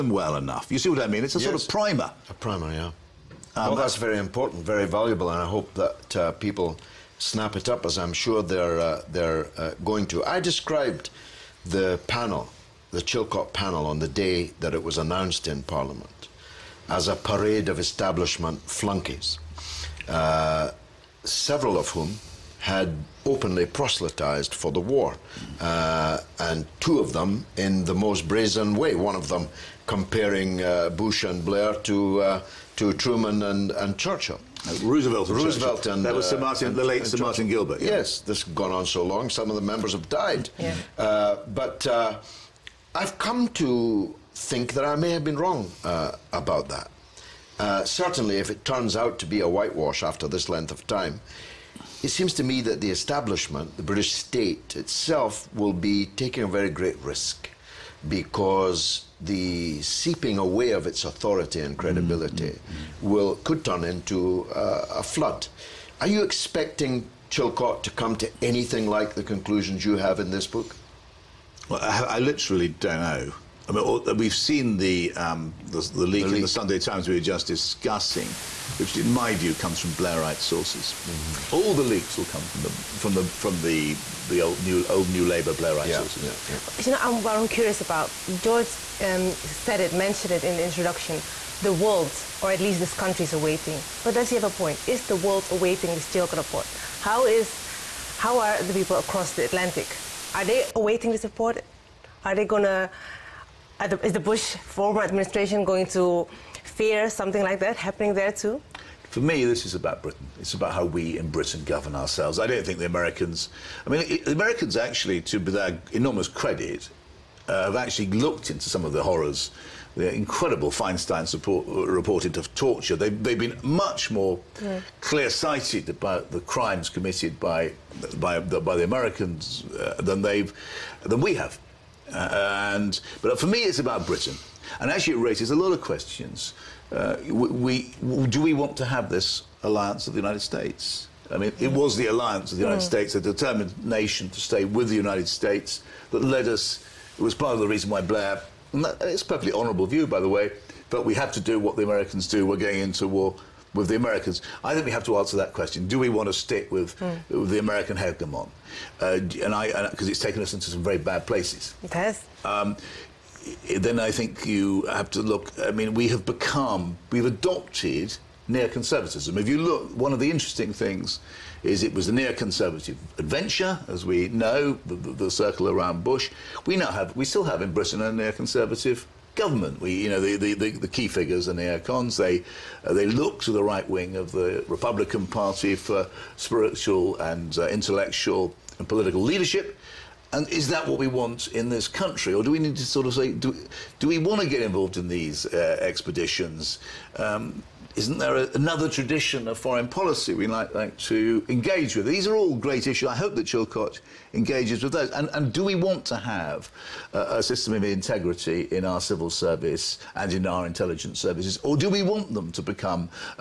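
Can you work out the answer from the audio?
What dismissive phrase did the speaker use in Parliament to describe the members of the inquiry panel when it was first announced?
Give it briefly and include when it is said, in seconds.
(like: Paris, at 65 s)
parade of establishment flunkies, at 17 s.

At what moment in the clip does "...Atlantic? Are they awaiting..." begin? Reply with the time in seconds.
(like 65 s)
99 s.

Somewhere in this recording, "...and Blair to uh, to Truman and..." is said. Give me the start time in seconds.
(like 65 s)
31 s.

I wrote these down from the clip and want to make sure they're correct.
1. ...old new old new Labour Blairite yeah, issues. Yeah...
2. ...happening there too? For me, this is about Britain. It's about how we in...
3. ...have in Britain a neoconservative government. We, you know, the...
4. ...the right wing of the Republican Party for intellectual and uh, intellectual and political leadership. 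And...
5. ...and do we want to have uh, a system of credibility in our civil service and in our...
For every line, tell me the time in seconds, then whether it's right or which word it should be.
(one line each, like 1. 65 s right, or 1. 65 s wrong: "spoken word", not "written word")
1. 84 s wrong: "sources", not "issues"
2. 107 s right
3. 177 s right
4. 183 s wrong: "spiritual", not "intellectual"
5. 205 s wrong: "integrity", not "credibility".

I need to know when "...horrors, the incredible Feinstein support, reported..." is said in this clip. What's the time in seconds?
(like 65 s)
119 s.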